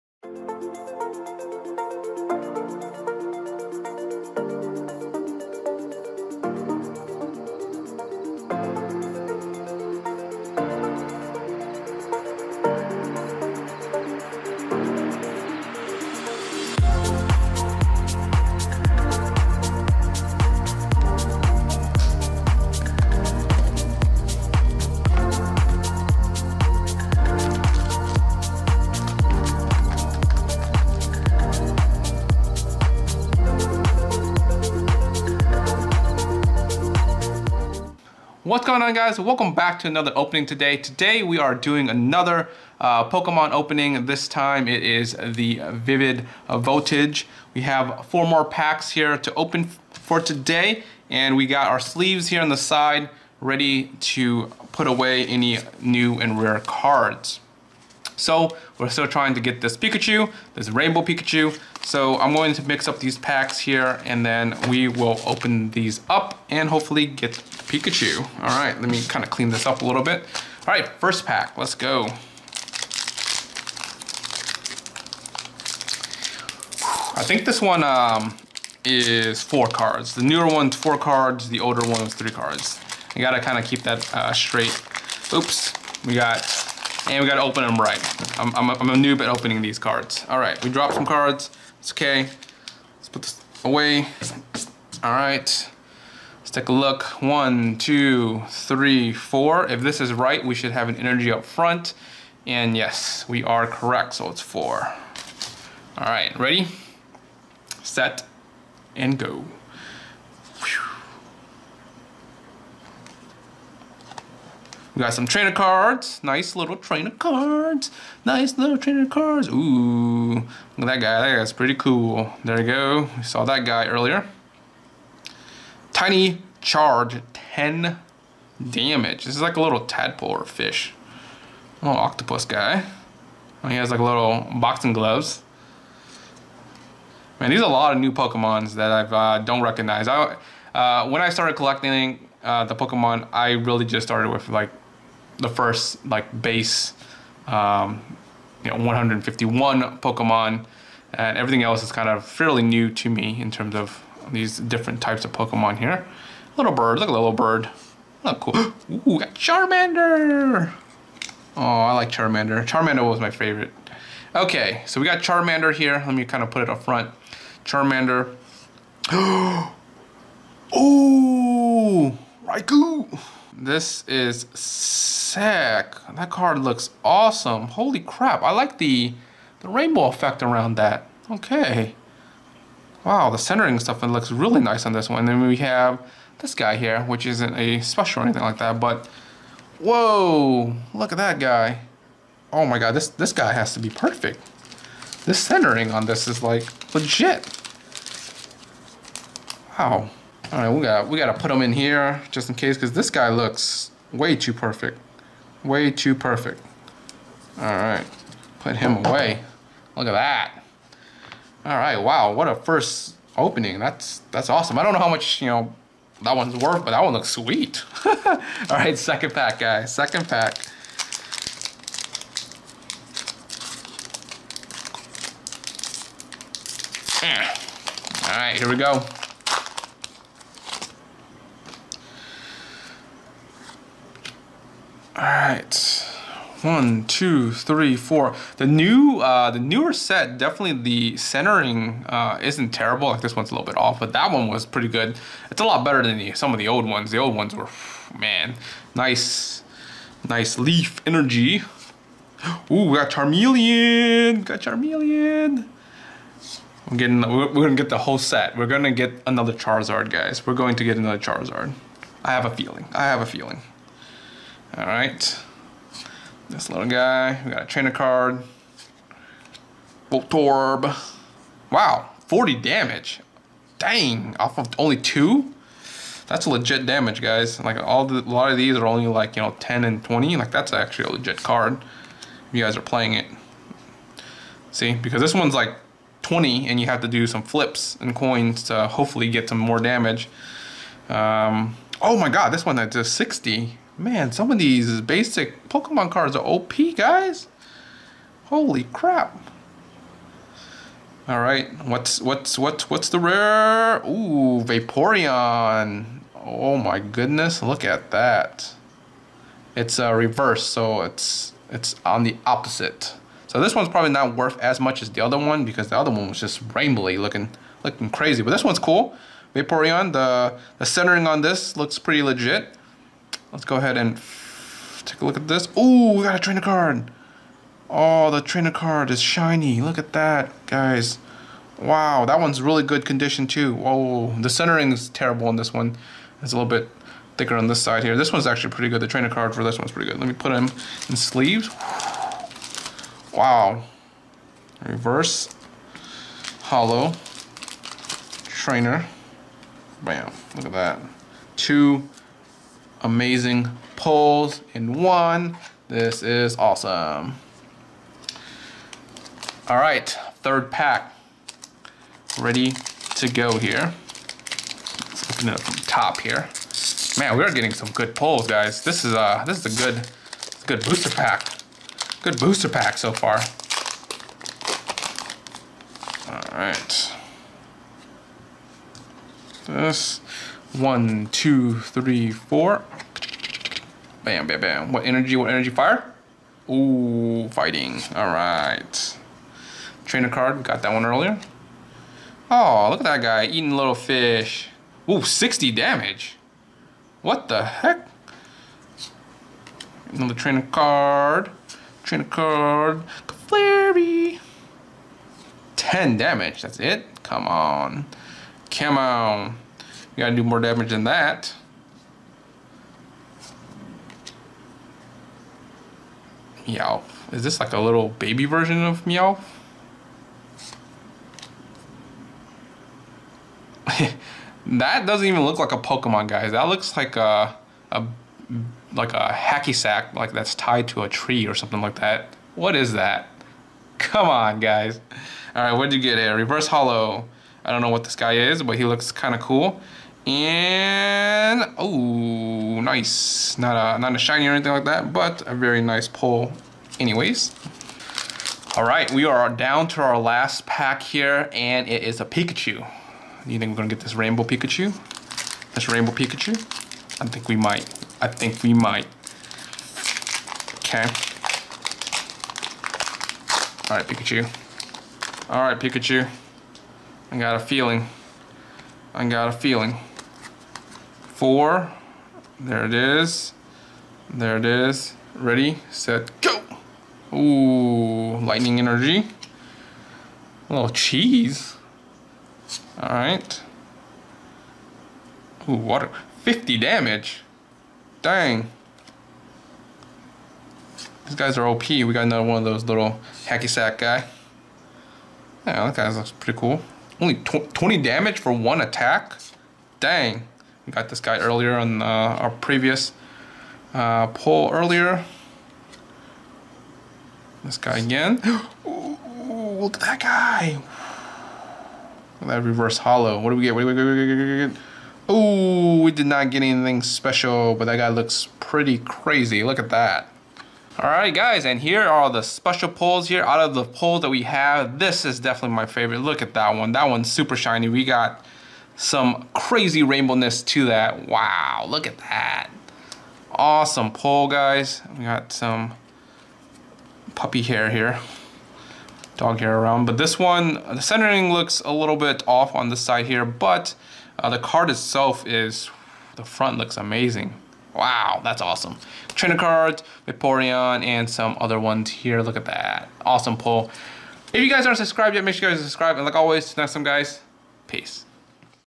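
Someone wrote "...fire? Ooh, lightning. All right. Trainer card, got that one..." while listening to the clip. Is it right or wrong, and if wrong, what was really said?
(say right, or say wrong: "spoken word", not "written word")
wrong: "fighting", not "lightning".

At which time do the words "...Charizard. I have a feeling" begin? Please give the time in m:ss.
4:21.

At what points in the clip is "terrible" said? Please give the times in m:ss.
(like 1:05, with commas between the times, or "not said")
4:02, 5:35.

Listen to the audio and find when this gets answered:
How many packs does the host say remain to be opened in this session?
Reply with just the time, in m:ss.
0:48.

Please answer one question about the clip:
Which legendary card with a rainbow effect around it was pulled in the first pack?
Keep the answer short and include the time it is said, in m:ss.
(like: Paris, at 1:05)
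Raikou, at 2:52.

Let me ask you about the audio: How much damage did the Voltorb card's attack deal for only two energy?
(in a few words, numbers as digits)
40.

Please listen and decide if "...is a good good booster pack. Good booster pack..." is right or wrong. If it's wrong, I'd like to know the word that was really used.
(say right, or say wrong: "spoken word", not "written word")
right.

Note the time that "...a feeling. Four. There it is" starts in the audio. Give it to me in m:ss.
7:49.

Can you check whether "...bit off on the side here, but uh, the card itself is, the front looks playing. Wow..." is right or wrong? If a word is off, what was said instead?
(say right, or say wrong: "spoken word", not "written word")
wrong: "amazing", not "playing".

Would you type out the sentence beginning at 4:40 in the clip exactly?
Like that's actually a legit card.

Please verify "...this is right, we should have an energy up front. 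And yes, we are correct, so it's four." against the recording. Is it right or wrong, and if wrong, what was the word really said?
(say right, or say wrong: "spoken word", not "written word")
right.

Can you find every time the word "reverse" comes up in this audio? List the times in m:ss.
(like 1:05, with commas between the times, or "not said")
5:10, 5:44, 7:16, 8:32.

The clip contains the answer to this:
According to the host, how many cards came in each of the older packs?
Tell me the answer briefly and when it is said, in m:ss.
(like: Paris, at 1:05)
3, at 1:22.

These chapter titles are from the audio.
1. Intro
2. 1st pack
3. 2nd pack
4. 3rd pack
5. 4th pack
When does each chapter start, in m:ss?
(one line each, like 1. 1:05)
1. 0:38
2. 1:10
3. 3:38
4. 5:59
5. 7:29.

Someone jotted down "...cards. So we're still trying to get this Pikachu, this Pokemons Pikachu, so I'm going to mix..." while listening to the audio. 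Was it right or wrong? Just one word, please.
wrong.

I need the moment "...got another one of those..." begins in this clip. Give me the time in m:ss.
8:12.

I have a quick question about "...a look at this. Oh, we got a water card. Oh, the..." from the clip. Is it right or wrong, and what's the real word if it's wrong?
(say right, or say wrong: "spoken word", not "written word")
wrong: "trainer", not "water".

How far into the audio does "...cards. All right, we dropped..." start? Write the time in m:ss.
1:29.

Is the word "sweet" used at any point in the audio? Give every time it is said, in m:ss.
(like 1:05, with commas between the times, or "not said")
3:37.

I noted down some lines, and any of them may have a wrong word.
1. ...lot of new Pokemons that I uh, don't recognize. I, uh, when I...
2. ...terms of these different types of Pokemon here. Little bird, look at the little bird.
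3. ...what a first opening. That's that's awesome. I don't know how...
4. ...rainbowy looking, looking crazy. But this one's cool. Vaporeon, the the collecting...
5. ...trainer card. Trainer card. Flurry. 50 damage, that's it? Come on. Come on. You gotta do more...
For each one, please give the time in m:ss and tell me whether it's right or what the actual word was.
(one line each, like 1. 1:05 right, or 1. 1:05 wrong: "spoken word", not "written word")
1. 2:17 right
2. 2:33 right
3. 3:32 right
4. 5:16 wrong: "centering", not "collecting"
5. 6:40 wrong: "10", not "50".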